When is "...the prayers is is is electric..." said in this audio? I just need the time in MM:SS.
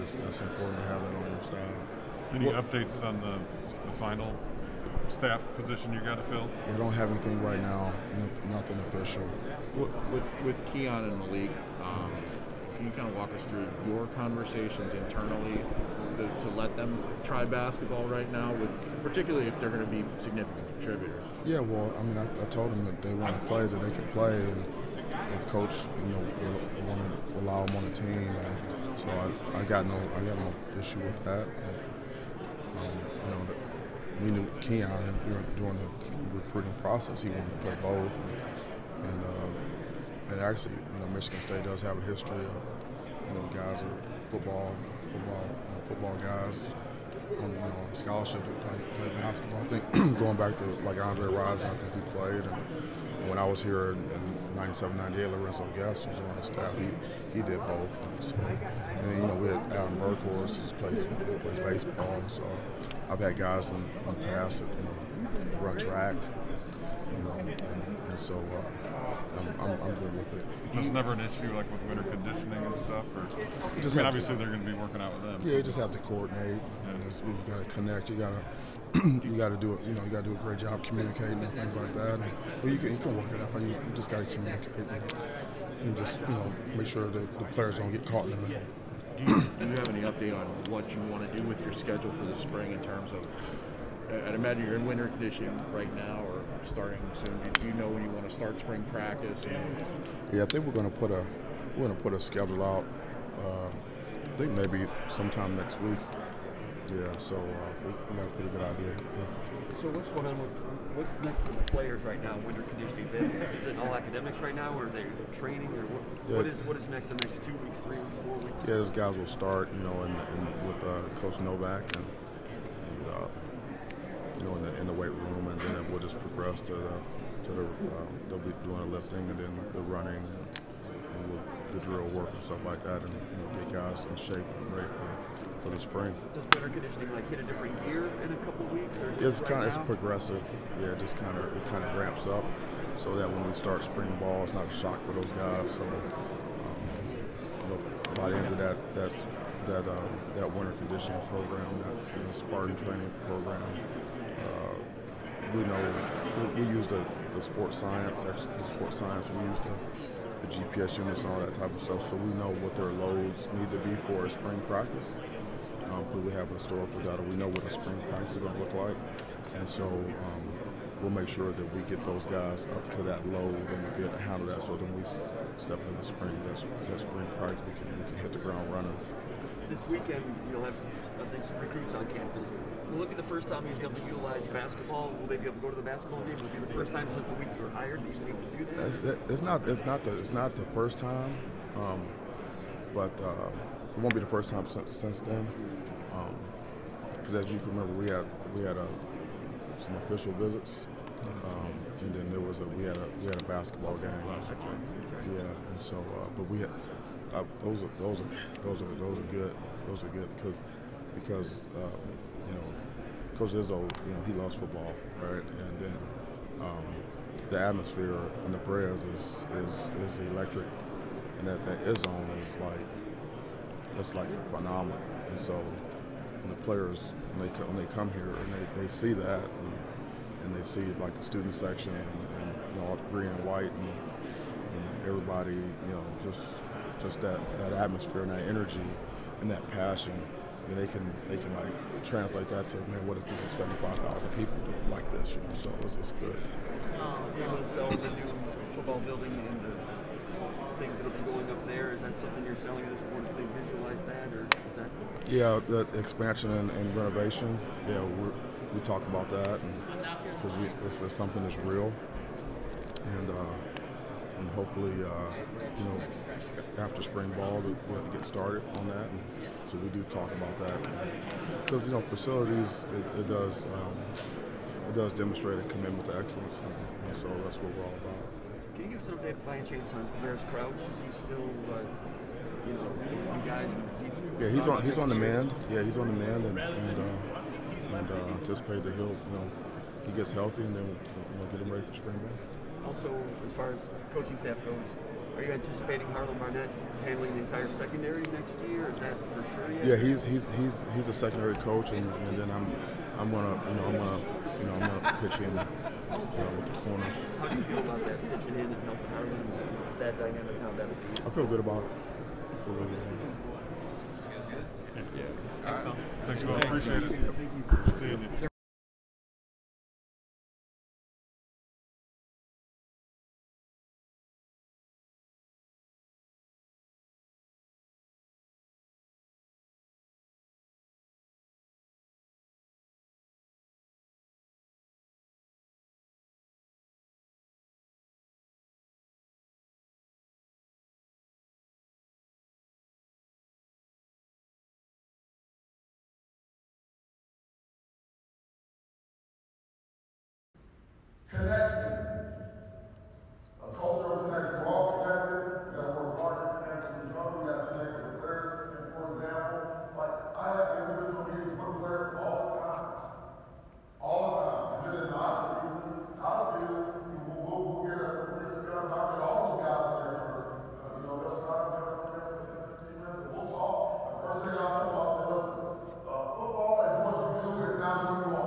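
03:38.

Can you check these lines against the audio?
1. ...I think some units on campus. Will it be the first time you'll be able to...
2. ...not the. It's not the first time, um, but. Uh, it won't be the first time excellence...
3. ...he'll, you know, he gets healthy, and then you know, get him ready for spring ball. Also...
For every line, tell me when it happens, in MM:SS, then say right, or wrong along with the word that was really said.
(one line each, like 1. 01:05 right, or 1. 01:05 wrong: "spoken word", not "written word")
1. 03:01 wrong: "recruits", not "units"
2. 03:09 wrong: "since", not "excellence"
3. 04:48 right.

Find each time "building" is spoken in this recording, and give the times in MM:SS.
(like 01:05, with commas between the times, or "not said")
04:08.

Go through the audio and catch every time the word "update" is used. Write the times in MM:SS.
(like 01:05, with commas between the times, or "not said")
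00:02, 01:30, 04:39.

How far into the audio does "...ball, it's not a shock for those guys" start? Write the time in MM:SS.
02:24.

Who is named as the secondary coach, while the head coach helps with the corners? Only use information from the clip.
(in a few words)
Harlan Barnett.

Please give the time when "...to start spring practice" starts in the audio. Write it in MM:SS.
01:38.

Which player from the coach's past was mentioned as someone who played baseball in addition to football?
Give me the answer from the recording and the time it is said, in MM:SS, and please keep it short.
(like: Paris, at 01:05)
Adam Berghorst, at 00:59.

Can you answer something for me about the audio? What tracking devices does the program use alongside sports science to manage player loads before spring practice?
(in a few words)
GPS units.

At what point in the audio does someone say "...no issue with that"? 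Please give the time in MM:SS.
00:30.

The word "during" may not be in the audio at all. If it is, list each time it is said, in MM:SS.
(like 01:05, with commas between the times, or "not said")
00:35.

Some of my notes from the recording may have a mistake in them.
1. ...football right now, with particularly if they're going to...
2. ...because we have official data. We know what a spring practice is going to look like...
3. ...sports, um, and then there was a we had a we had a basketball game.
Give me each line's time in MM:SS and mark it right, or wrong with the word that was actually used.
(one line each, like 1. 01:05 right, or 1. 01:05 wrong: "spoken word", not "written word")
1. 00:17 wrong: "basketball", not "football"
2. 02:46 wrong: "historical", not "official"
3. 03:20 wrong: "visits", not "sports".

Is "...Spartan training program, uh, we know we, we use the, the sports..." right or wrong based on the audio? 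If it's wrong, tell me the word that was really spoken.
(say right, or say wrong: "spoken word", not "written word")
right.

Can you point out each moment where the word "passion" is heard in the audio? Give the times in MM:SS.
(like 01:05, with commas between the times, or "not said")
03:59.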